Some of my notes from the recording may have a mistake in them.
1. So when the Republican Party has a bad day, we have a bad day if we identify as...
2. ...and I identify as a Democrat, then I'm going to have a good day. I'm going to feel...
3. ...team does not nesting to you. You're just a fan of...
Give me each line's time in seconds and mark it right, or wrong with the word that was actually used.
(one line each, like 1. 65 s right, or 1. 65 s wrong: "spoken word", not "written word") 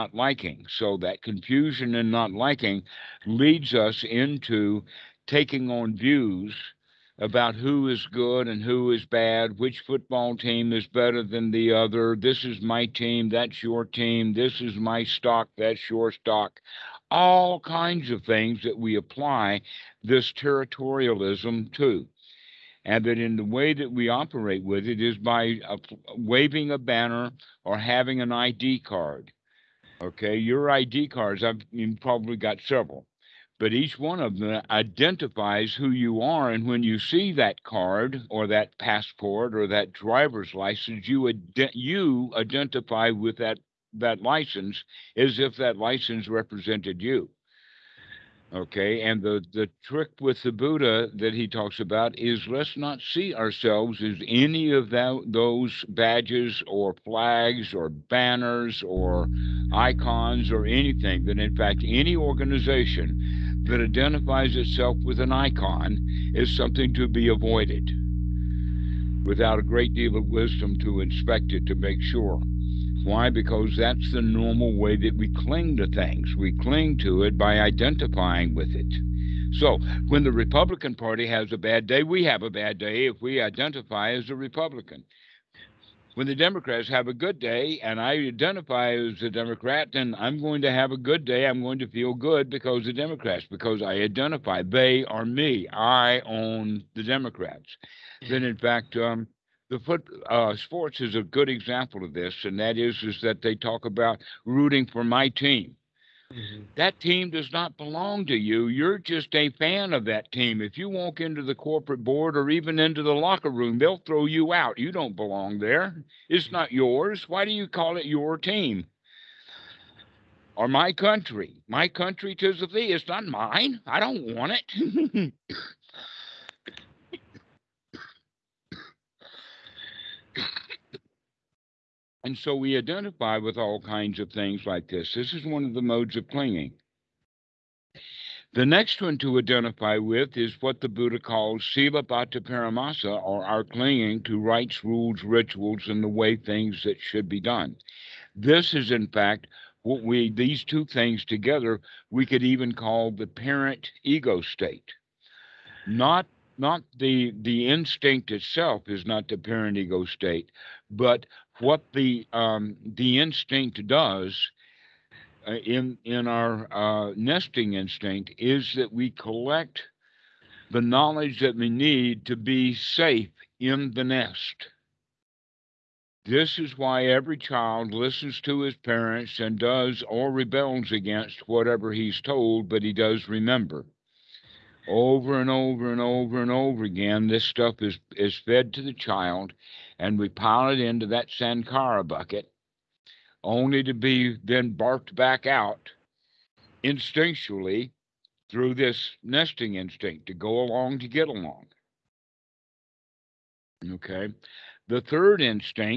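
1. 79 s right
2. 87 s right
3. 106 s wrong: "belong", not "nesting".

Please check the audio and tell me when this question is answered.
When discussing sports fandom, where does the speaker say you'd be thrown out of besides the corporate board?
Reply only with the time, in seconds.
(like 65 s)
113 s.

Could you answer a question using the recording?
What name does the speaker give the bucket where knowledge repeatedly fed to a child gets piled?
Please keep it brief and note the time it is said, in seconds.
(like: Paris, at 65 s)
Sankara bucket, at 191 s.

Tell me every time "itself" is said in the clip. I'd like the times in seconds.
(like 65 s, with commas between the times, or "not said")
64 s, 158 s.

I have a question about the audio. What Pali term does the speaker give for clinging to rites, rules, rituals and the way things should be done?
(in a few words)
Sila Bhatta Paramasa.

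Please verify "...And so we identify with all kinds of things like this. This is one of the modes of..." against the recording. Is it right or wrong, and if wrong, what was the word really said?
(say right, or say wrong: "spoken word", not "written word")
right.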